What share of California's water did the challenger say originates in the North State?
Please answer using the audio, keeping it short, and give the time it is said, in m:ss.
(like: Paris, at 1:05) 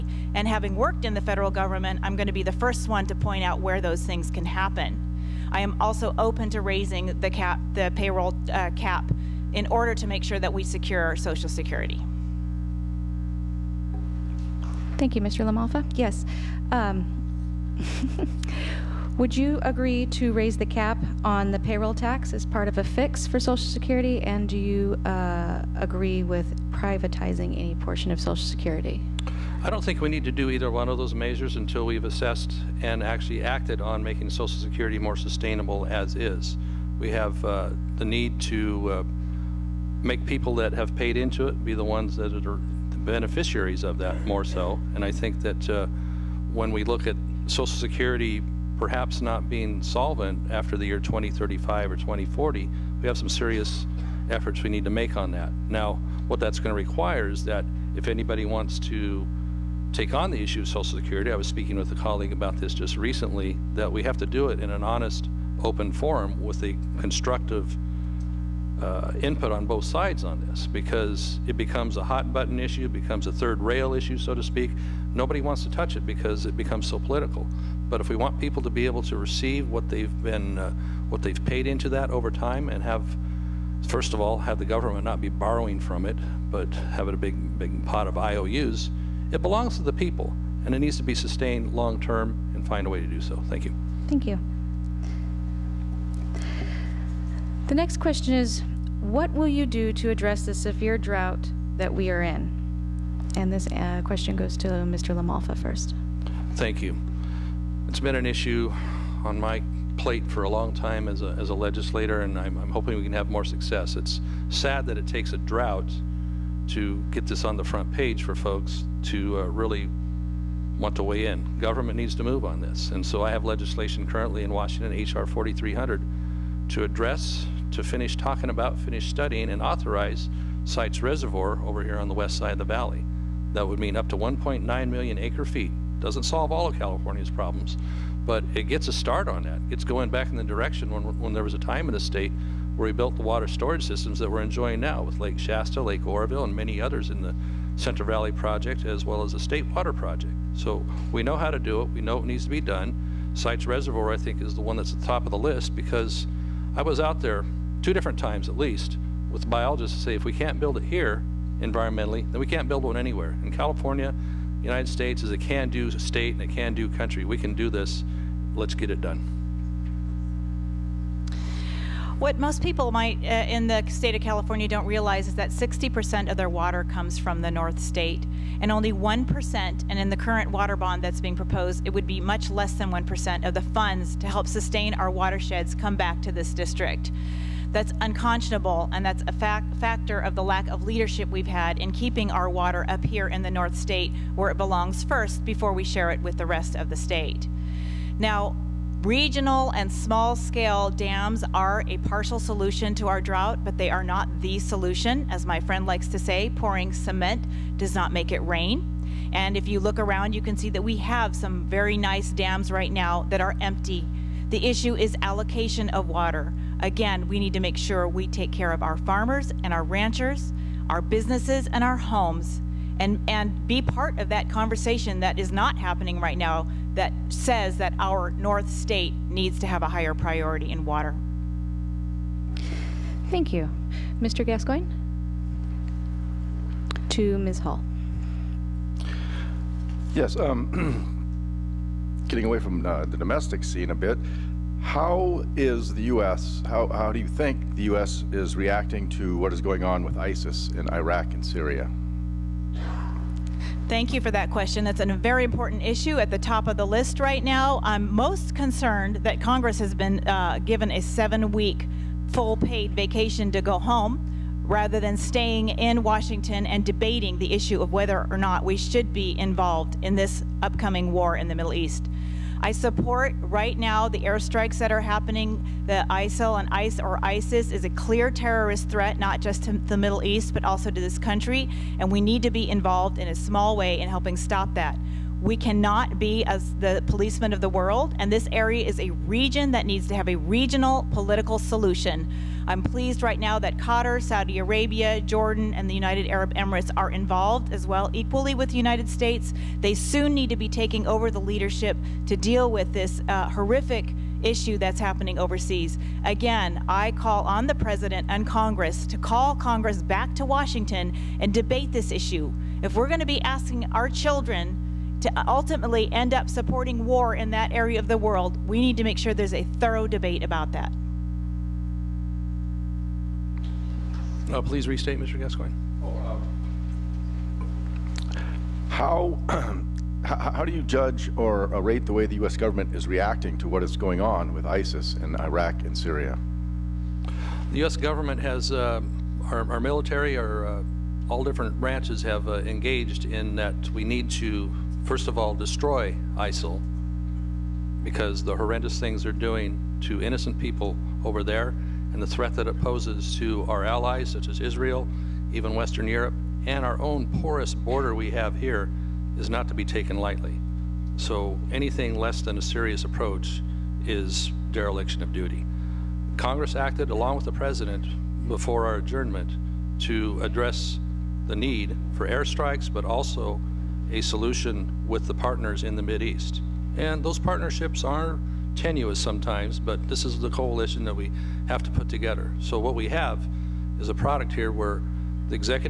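60%, at 2:55.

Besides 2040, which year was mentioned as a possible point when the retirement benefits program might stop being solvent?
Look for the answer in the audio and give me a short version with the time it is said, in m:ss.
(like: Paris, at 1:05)
2035, at 0:50.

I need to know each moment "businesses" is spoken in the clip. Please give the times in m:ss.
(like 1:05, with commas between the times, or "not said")
3:41.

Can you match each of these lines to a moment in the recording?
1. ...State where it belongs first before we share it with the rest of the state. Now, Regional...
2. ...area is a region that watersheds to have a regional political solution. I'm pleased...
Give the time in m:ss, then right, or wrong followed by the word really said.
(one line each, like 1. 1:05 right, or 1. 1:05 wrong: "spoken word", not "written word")
1. 3:13 right
2. 4:48 wrong: "needs", not "watersheds".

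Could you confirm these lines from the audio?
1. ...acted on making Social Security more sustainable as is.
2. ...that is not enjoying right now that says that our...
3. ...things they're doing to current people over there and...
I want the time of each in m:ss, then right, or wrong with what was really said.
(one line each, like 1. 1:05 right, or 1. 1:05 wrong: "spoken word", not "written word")
1. 0:33 right
2. 3:45 wrong: "happening", not "enjoying"
3. 5:48 wrong: "innocent", not "current".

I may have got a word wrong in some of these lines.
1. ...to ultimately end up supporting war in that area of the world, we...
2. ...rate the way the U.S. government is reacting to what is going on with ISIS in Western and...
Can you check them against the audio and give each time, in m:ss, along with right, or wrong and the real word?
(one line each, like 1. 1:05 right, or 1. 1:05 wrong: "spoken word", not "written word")
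1. 5:15 right
2. 5:31 wrong: "Iraq", not "Western".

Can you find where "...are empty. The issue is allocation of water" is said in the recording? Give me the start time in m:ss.
3:33.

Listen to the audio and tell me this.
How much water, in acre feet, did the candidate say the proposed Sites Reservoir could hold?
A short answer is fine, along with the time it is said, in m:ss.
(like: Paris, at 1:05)
1.9 million acre feet, at 2:14.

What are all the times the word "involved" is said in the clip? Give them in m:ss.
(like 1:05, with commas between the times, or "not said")
4:29, 4:42, 4:57.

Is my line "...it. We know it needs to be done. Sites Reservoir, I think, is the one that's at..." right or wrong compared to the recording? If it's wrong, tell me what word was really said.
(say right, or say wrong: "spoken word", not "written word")
right.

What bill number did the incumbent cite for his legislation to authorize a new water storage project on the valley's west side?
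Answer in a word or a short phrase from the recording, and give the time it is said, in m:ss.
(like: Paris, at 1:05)
H.R. 4300, at 2:04.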